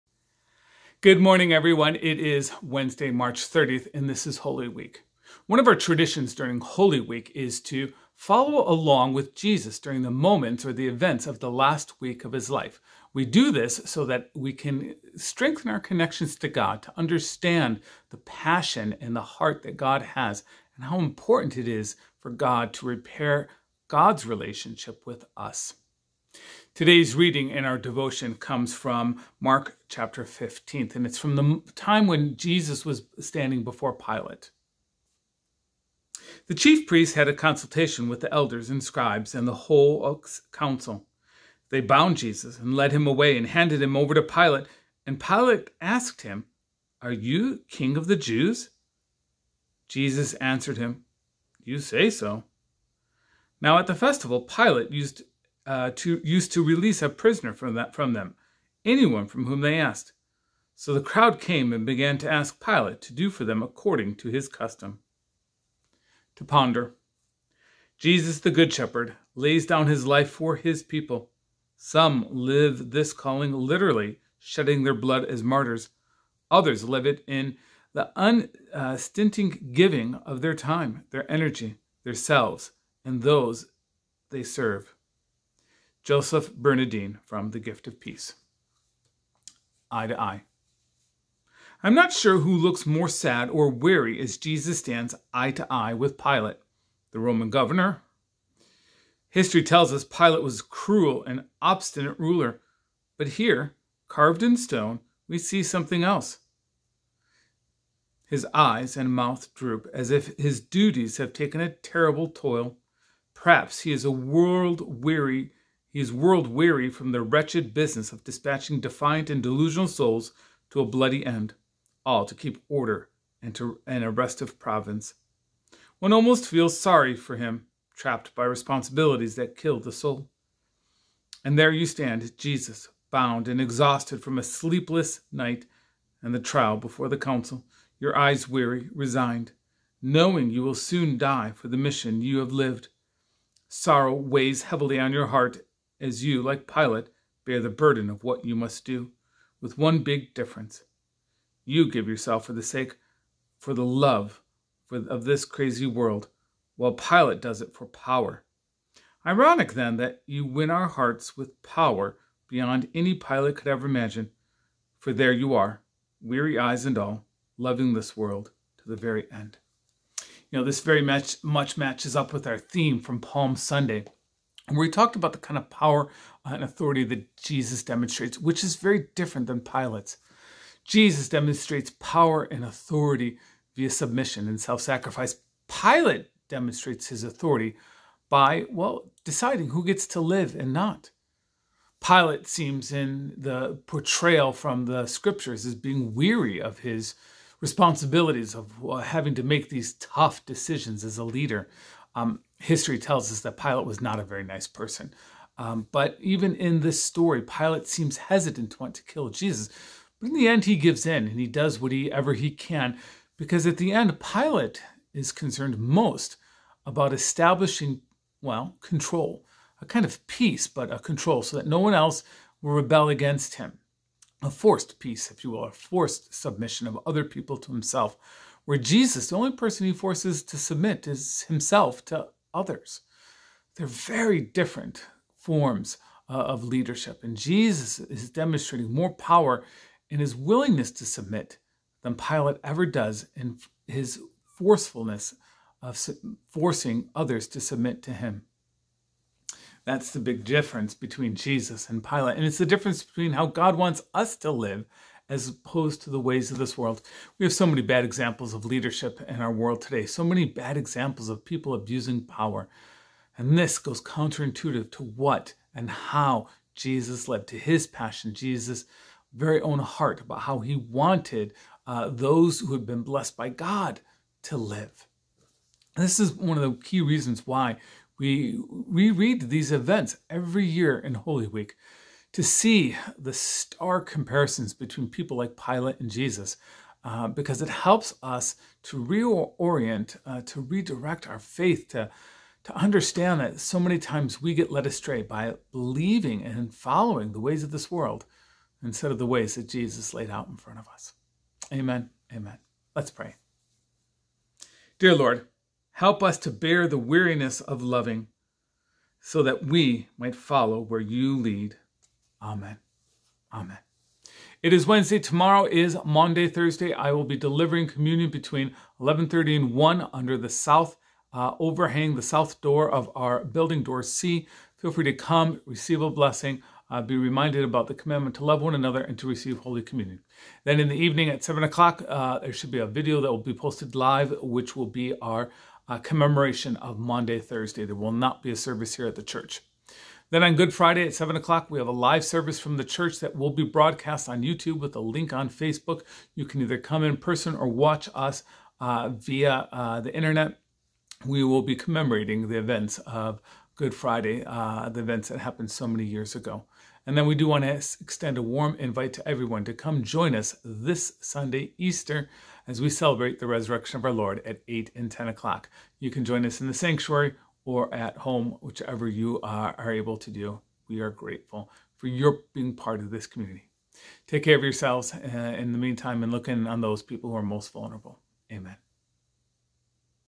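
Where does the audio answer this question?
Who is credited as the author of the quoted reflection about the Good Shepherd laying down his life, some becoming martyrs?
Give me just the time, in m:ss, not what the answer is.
1:26.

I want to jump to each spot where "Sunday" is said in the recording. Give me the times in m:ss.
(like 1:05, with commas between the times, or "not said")
2:53, 6:01.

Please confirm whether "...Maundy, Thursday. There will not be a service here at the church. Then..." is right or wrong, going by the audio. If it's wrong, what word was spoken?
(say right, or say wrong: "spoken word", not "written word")
right.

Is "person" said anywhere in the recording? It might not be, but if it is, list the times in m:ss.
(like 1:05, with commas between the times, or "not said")
3:24, 3:49, 5:47.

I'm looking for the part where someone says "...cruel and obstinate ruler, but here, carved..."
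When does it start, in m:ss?
1:40.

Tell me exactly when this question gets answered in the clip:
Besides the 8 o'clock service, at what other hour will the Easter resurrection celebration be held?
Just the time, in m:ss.
6:05.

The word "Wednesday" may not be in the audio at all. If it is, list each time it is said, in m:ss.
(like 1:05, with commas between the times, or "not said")
0:02, 5:14.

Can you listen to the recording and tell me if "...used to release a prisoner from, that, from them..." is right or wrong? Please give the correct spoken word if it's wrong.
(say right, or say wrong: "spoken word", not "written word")
right.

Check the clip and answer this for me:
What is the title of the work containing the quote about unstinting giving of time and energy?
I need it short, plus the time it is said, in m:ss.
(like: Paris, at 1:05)
The Gift of Peace, at 1:27.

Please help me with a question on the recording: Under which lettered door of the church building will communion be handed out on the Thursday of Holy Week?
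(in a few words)
Door C.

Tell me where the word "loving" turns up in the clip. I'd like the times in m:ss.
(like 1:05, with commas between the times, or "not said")
2:47, 5:07.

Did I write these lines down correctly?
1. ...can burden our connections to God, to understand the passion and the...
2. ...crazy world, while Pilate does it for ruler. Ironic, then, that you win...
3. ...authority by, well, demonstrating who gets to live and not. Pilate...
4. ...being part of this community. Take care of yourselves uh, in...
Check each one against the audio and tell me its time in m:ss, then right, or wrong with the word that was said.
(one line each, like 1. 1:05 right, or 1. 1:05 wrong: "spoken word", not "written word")
1. 0:14 wrong: "strengthen", not "burden"
2. 2:35 wrong: "power", not "ruler"
3. 3:07 wrong: "deciding", not "demonstrating"
4. 6:12 right.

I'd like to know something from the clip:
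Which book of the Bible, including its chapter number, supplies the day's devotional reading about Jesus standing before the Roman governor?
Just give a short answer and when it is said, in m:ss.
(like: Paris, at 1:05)
Mark 15, at 0:29.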